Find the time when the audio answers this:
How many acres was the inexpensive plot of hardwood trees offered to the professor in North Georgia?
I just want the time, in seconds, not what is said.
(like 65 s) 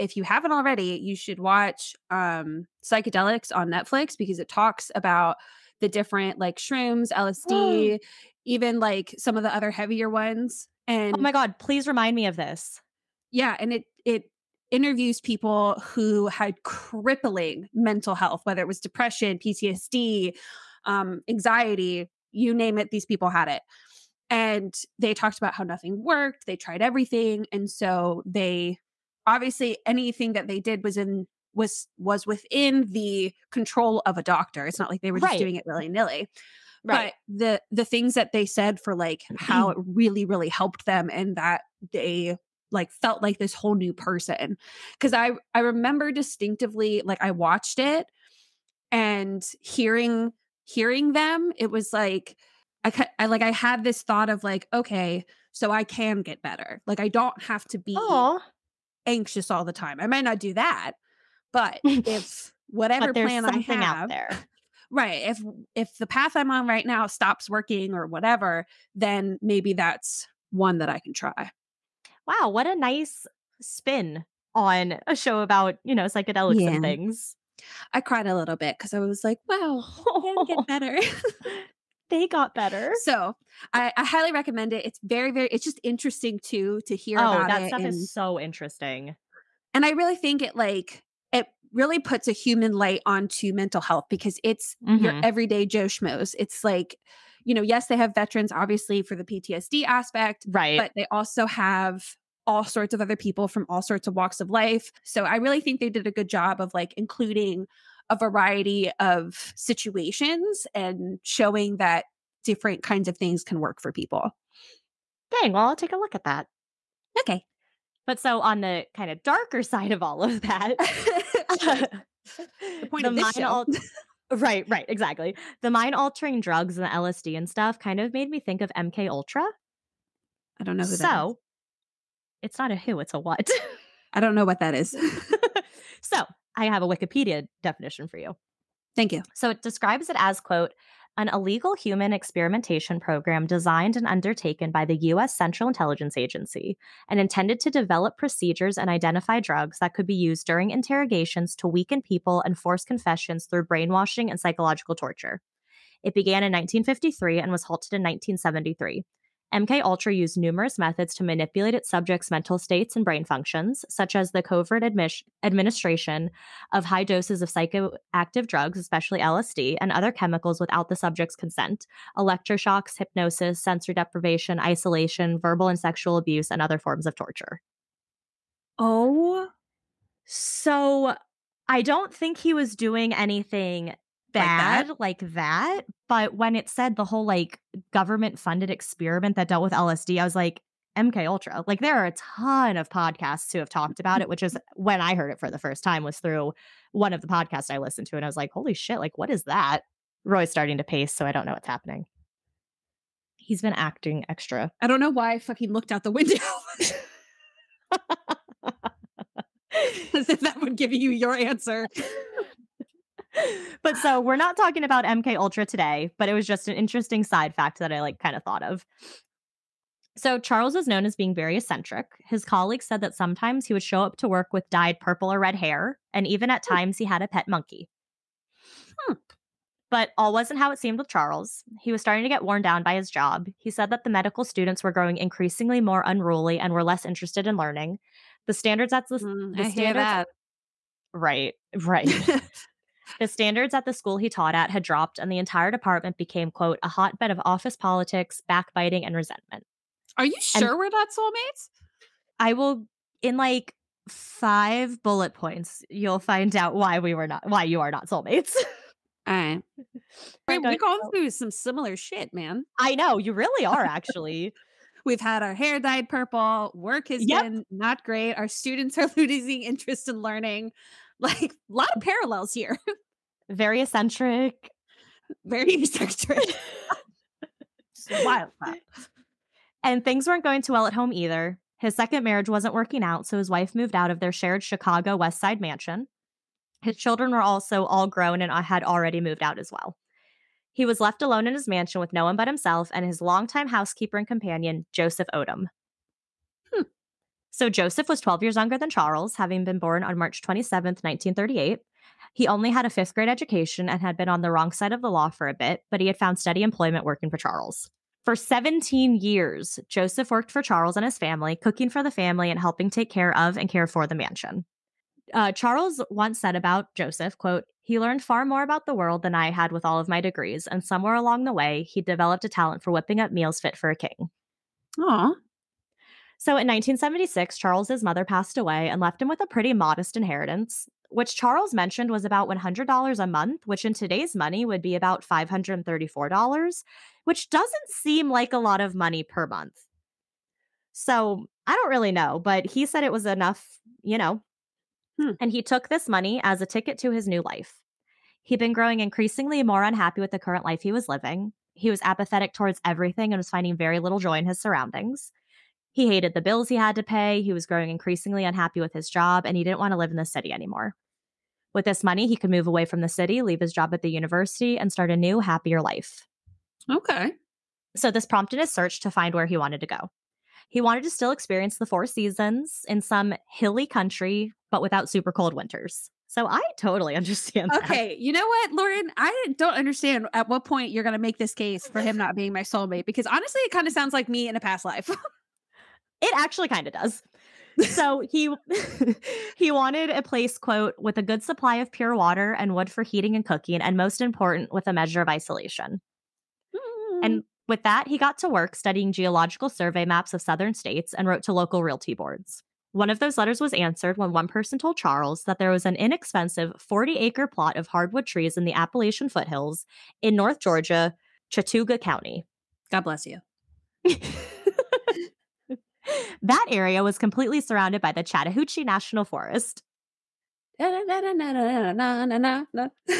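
406 s.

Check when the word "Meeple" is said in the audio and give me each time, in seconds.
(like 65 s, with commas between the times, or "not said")
not said.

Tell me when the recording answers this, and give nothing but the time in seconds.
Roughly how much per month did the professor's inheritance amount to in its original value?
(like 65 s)
332 s.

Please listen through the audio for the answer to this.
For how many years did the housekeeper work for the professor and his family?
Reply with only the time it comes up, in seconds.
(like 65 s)
308 s.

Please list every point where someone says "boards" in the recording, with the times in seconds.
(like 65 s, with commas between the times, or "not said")
402 s.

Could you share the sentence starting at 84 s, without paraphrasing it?
It's very, very, it's just interesting too to hear oh, about that it stuff and, is so interesting.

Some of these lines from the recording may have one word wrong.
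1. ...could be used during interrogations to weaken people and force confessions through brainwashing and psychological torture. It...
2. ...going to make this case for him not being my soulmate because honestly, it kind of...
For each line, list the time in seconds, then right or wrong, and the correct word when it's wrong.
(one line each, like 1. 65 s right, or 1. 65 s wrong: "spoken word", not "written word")
1. 149 s right
2. 381 s right.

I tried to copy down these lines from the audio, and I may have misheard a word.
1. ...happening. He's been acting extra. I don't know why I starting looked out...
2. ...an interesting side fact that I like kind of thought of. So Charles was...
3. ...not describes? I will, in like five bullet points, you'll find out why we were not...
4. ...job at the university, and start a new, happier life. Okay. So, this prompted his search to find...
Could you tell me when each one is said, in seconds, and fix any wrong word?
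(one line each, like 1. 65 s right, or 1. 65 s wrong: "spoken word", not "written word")
1. 201 s wrong: "fucking", not "starting"
2. 216 s right
3. 250 s wrong: "soulmates", not "describes"
4. 363 s right.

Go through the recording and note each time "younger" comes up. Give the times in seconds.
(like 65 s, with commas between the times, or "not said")
298 s.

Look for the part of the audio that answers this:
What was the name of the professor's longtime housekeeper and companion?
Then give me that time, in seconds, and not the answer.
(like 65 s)
294 s.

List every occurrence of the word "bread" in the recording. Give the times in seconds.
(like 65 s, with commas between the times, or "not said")
not said.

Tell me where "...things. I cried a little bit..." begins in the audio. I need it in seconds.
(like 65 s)
76 s.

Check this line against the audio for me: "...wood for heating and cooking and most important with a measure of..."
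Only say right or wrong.
right.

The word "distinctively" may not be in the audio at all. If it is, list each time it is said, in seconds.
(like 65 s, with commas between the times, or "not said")
46 s.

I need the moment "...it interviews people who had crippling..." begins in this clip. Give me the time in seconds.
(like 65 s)
14 s.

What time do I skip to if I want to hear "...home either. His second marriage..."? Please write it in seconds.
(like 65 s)
280 s.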